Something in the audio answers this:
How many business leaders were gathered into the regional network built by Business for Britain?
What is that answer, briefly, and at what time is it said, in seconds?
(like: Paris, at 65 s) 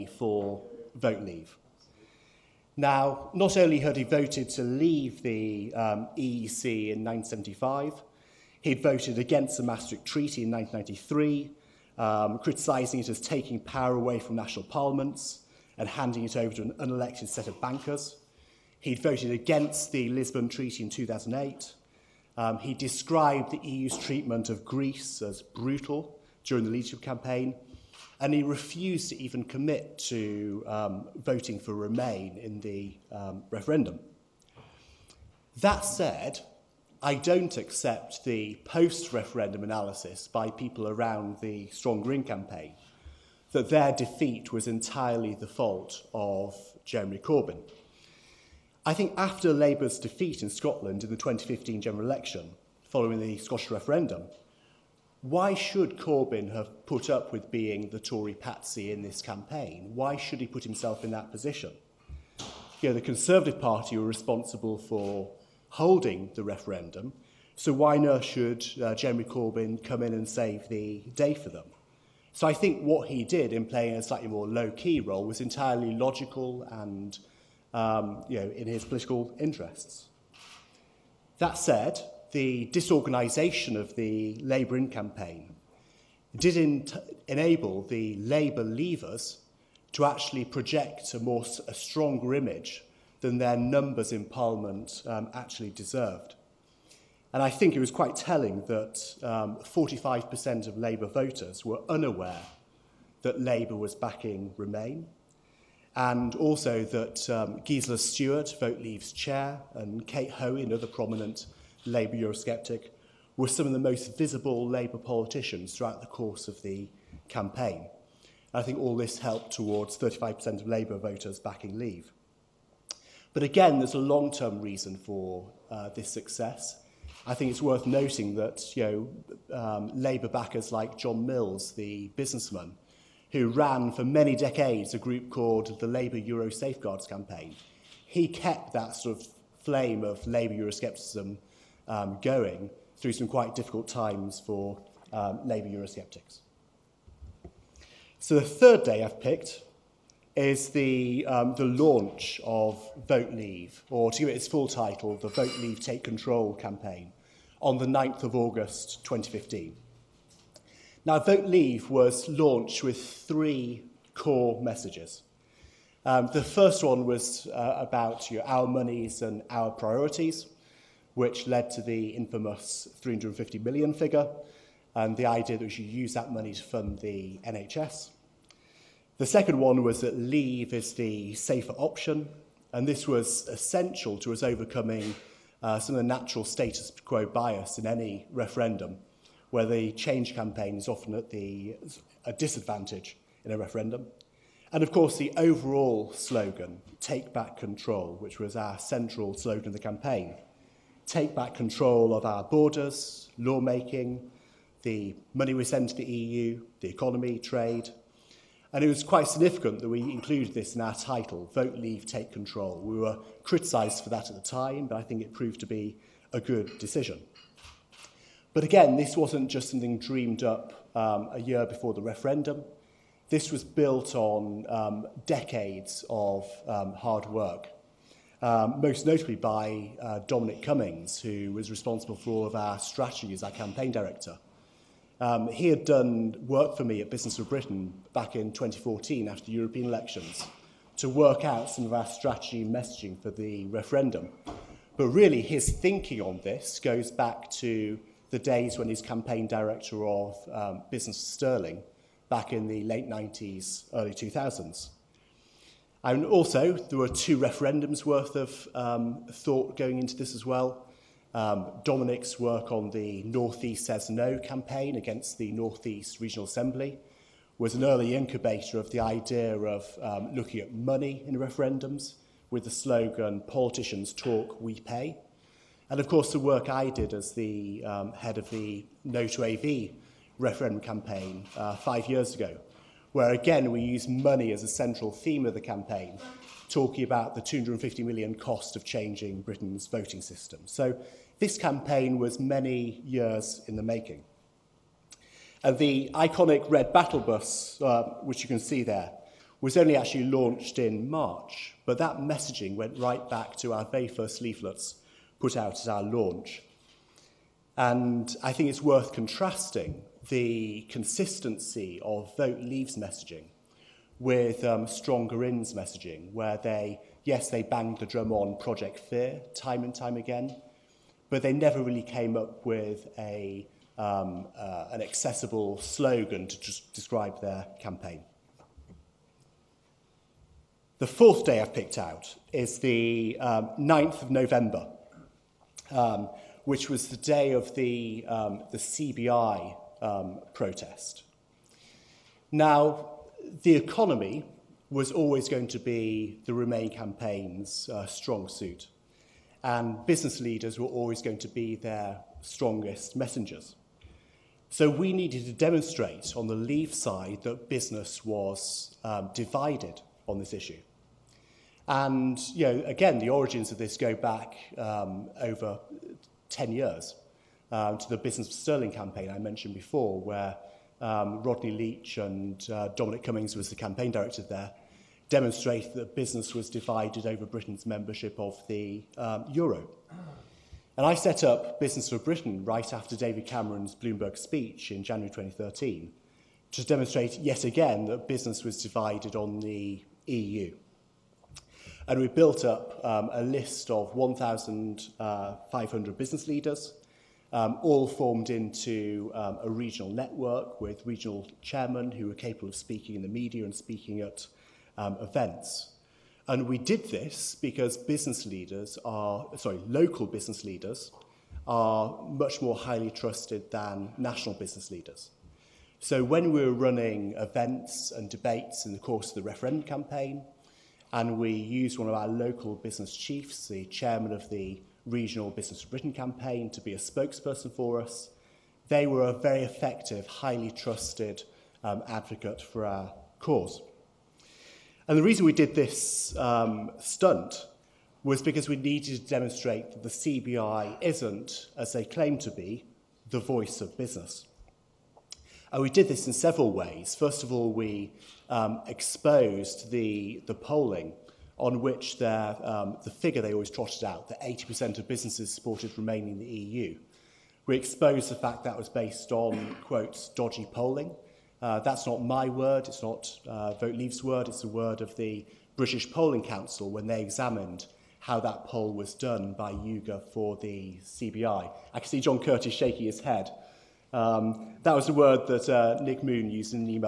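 1,500, at 394 s.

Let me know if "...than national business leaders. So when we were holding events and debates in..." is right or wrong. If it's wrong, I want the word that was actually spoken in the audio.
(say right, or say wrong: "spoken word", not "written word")
wrong: "running", not "holding".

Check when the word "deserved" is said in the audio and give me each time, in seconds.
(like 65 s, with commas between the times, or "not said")
95 s.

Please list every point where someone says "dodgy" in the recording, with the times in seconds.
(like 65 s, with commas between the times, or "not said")
460 s.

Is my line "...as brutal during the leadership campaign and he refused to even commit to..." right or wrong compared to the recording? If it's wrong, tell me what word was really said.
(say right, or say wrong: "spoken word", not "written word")
right.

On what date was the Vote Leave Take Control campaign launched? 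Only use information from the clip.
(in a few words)
9 August 2015.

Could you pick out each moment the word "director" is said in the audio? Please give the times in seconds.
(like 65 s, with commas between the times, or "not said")
233 s, 249 s, 374 s.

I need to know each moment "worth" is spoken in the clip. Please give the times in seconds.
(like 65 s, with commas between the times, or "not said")
127 s, 258 s, 308 s.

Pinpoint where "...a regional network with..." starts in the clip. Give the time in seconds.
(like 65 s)
399 s.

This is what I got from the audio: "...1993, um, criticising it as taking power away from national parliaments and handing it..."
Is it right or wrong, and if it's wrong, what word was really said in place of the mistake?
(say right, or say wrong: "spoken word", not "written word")
right.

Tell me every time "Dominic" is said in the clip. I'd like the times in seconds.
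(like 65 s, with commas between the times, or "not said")
230 s, 261 s, 372 s.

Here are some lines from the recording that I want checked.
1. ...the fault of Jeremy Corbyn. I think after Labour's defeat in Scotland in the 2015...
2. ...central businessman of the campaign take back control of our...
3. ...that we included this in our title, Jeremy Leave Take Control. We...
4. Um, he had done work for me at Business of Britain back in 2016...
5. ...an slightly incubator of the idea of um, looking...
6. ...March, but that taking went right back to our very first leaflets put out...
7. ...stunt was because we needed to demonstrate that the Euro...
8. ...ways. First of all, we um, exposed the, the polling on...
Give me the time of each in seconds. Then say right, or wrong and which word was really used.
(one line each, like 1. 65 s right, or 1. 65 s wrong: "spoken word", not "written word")
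1. 45 s right
2. 198 s wrong: "slogan", not "businessman"
3. 209 s wrong: "Vote", not "Jeremy"
4. 235 s wrong: "2014", not "2016"
5. 267 s wrong: "early", not "slightly"
6. 301 s wrong: "messaging", not "taking"
7. 436 s wrong: "CBI", not "Euro"
8. 446 s right.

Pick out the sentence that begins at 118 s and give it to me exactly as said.
I think all this helped towards 35% of Labour voters backing Leave.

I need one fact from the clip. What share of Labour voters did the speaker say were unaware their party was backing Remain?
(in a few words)
45%.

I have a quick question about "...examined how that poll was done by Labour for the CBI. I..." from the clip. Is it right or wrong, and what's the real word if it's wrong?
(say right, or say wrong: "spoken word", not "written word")
wrong: "YouGov", not "Labour".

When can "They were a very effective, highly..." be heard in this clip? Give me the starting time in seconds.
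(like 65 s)
428 s.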